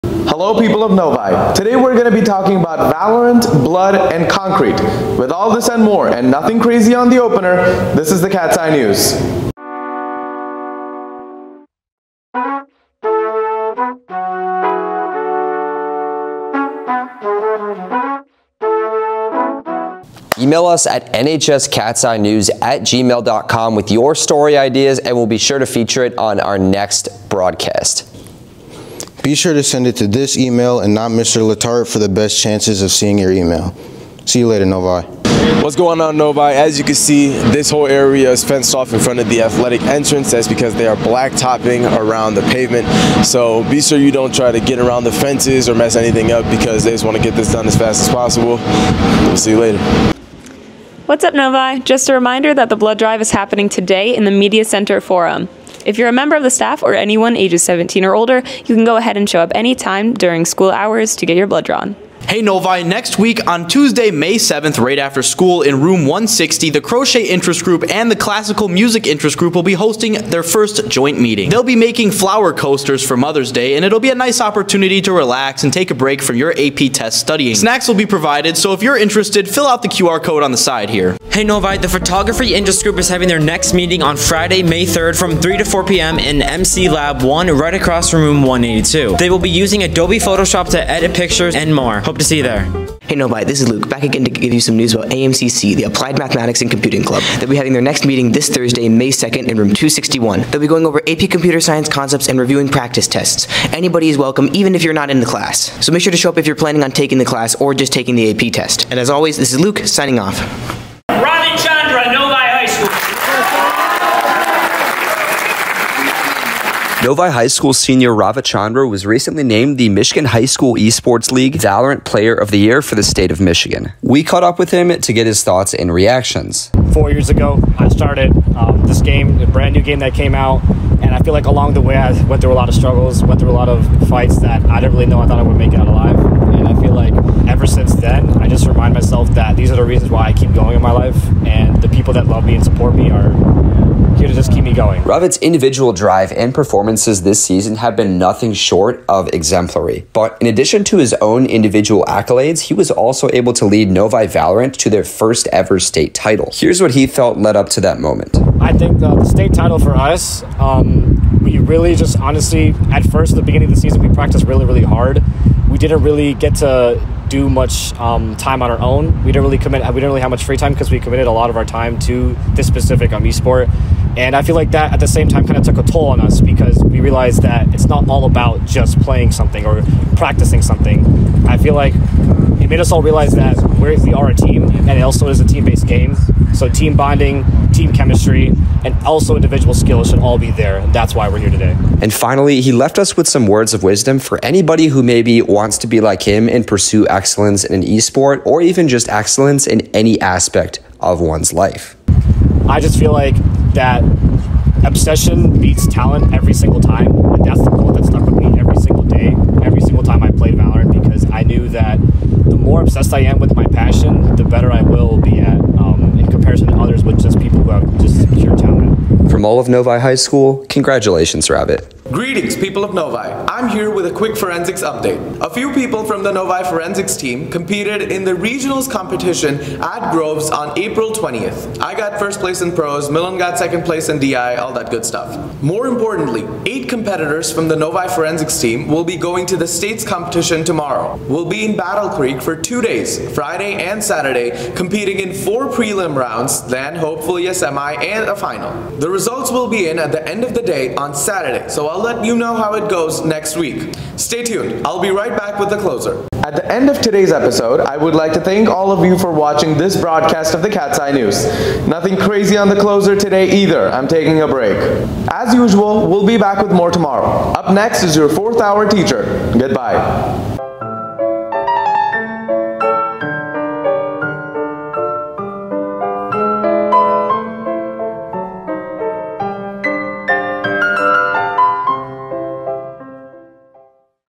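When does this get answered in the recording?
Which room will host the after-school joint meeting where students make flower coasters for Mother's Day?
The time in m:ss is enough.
1:05.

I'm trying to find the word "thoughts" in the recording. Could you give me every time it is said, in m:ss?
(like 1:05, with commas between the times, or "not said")
2:05, 2:15.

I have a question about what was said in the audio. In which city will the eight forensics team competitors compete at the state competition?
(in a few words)
Battle Creek.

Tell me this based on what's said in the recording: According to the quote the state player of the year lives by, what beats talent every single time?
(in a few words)
Obsession.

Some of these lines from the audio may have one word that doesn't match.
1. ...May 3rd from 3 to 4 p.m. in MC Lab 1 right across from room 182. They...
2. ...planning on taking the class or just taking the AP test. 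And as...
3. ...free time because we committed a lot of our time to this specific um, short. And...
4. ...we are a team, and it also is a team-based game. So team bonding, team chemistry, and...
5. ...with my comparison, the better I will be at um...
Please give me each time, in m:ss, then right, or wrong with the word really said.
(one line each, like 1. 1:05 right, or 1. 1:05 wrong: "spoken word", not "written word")
1. 1:24 right
2. 1:46 right
3. 2:50 wrong: "esport", not "short"
4. 3:03 right
5. 3:33 wrong: "passion", not "comparison".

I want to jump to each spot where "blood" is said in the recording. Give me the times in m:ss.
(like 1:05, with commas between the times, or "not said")
0:03, 0:52, 1:01.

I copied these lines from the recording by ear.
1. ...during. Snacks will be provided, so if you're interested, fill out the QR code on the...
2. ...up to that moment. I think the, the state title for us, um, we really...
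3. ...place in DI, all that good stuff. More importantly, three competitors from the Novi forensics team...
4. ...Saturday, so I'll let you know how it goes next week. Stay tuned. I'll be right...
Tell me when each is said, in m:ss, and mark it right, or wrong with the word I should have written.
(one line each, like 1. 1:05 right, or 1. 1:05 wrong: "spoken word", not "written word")
1. 1:17 wrong: "studying", not "during"
2. 2:37 right
3. 3:53 wrong: "eight", not "three"
4. 4:11 right.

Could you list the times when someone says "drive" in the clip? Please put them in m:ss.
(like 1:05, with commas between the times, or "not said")
0:52, 2:25.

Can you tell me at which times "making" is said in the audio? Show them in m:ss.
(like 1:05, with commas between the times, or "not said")
1:11.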